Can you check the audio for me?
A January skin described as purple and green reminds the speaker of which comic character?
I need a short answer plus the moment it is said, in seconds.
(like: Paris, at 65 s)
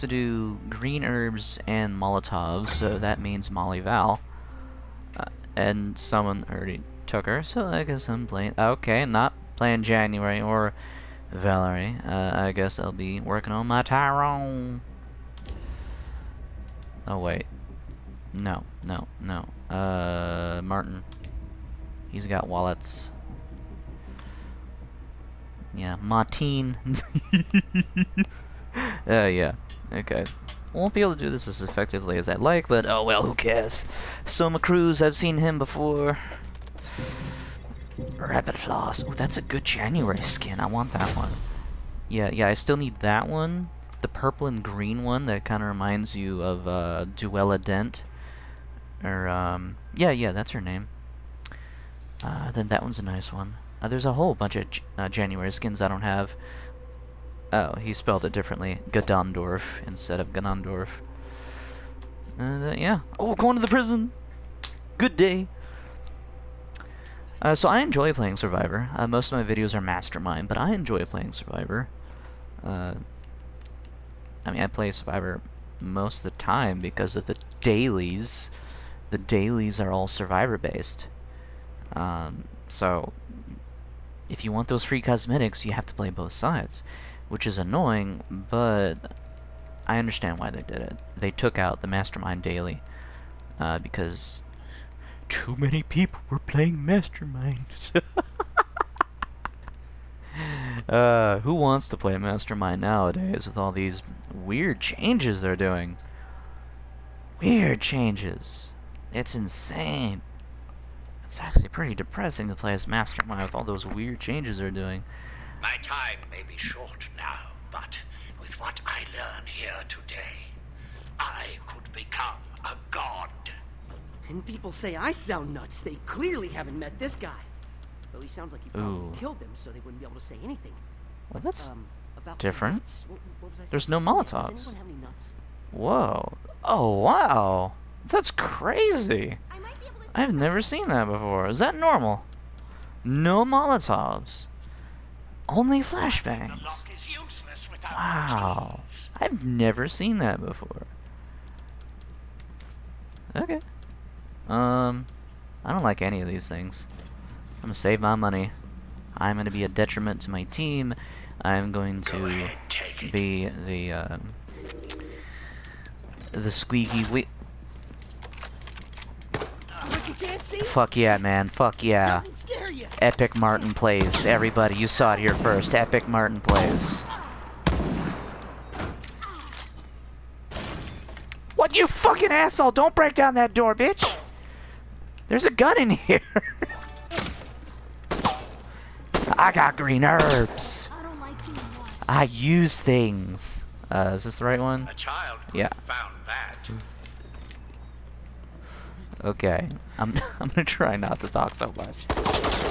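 Duela Dent, at 47 s.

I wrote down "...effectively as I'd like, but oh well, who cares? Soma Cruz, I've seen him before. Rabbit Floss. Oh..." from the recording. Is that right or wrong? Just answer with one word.
right.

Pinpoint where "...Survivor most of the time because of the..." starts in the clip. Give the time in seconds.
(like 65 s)
74 s.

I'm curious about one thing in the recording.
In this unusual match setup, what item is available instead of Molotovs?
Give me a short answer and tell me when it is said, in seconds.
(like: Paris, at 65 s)
Flashbangs, at 145 s.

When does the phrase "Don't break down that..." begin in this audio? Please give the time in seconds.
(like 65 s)
182 s.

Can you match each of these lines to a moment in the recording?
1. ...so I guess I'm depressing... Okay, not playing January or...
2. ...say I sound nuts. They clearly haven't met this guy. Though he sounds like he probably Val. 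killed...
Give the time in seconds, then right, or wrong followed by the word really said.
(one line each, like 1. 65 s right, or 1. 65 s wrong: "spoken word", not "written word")
1. 7 s wrong: "playing", not "depressing"
2. 124 s wrong: "Ooh", not "Val".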